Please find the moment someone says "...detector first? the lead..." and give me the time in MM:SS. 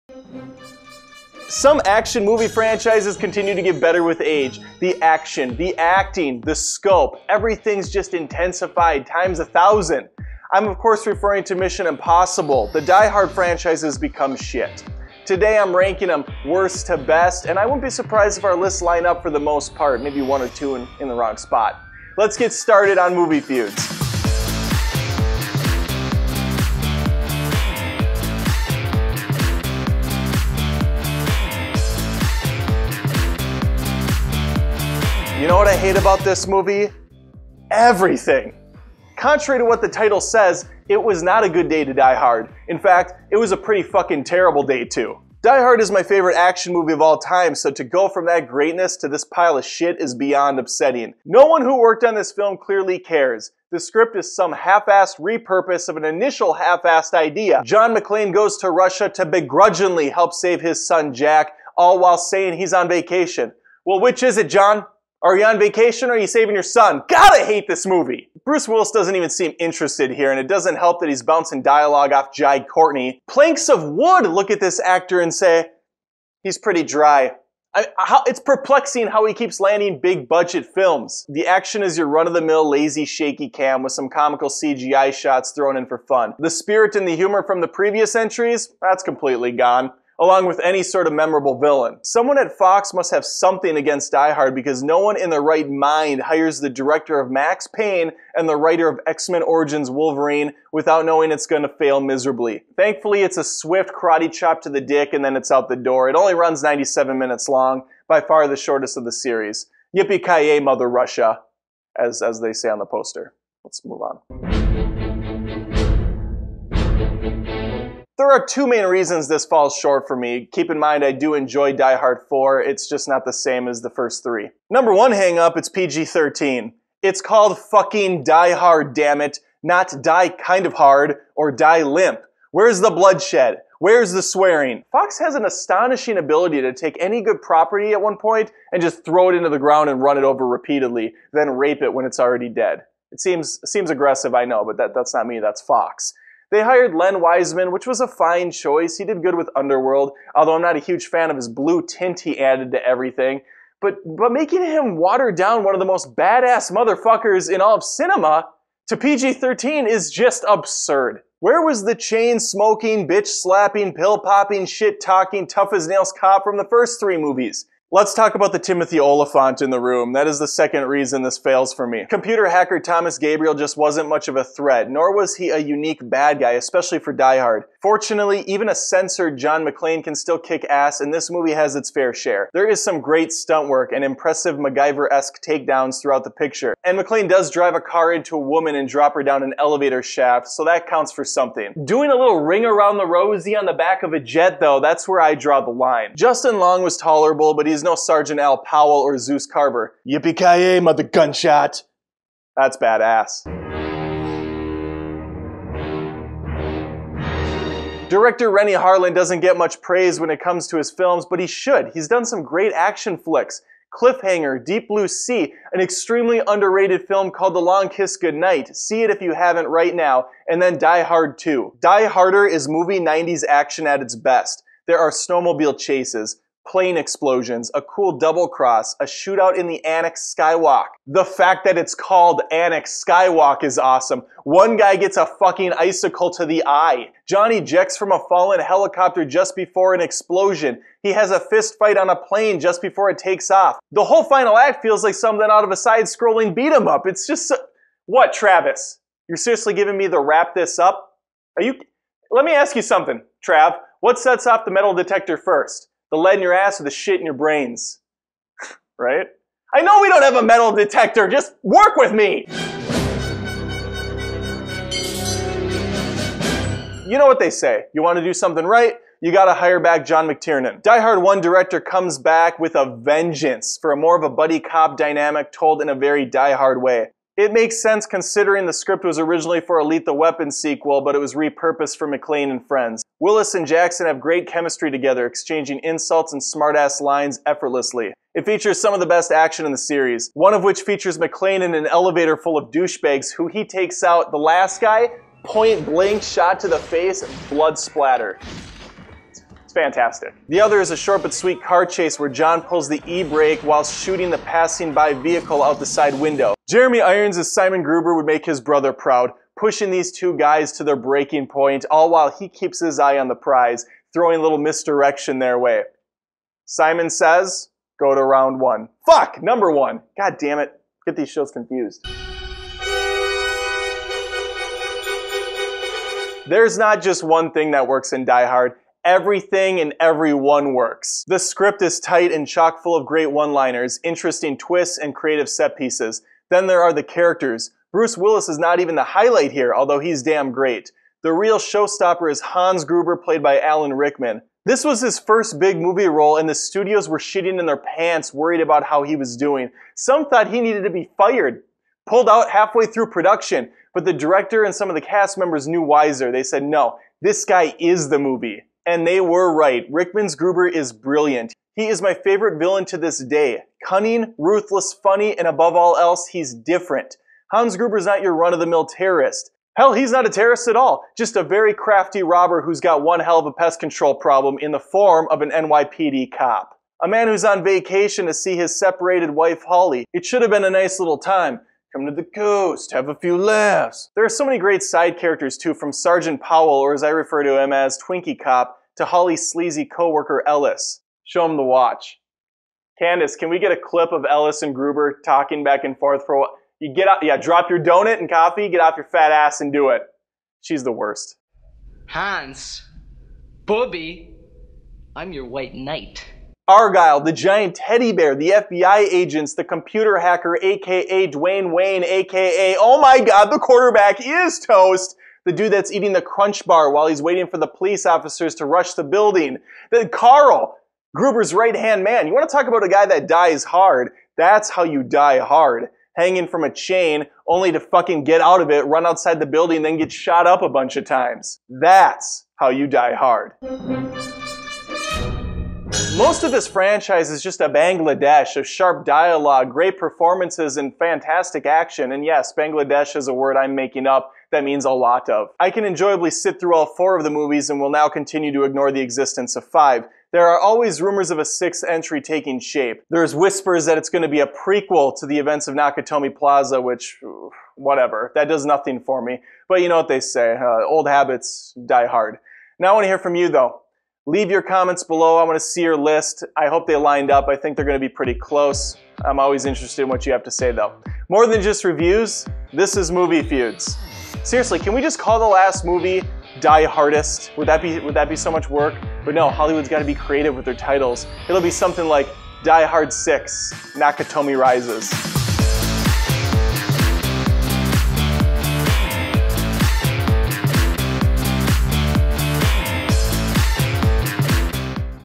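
04:14.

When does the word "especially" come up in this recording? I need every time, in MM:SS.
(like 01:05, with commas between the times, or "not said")
02:56.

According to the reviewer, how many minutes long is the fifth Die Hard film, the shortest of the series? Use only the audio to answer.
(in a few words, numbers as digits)
97.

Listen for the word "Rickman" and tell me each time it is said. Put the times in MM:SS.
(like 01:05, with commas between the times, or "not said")
05:43, 05:59.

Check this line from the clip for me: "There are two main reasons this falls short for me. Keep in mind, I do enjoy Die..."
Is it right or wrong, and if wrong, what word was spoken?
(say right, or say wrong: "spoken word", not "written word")
right.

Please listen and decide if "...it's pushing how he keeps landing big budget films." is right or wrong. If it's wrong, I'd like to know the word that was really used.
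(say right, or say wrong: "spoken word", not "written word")
wrong: "perplexing", not "pushing".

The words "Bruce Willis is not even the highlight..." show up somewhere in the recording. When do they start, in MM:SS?
05:37.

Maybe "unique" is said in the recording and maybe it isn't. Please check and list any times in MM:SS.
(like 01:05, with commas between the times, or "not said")
02:55.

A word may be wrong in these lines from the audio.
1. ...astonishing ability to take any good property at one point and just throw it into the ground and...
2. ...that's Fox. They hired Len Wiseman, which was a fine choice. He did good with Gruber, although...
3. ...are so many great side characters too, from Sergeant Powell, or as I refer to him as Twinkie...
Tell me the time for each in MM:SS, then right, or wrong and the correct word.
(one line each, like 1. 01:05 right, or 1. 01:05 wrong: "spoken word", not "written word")
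1. 02:15 right
2. 02:25 wrong: "Underworld", not "Gruber"
3. 06:24 right.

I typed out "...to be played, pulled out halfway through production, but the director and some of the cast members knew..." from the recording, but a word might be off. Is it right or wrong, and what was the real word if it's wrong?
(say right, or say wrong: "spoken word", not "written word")
wrong: "fired", not "played".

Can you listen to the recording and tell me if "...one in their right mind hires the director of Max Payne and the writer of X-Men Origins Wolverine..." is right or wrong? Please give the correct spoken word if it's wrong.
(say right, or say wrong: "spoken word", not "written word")
right.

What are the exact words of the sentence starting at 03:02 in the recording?
There is some great stunt work and impressive MacGyver-esque takedowns throughout the picture.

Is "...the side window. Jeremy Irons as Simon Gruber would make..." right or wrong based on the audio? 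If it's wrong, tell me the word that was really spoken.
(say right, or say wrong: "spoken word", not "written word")
right.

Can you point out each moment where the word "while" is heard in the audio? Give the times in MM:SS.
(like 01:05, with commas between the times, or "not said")
01:01, 05:03, 05:12, 06:36, 06:56.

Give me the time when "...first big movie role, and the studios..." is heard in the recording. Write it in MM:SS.
05:45.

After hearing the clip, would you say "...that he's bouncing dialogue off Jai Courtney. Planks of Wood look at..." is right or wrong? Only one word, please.
right.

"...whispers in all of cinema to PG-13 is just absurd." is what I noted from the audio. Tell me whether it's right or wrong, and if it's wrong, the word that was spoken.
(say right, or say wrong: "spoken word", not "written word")
wrong: "motherfuckers", not "whispers".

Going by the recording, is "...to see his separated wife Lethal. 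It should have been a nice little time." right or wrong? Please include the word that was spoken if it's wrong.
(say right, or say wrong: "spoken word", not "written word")
wrong: "Holly", not "Lethal".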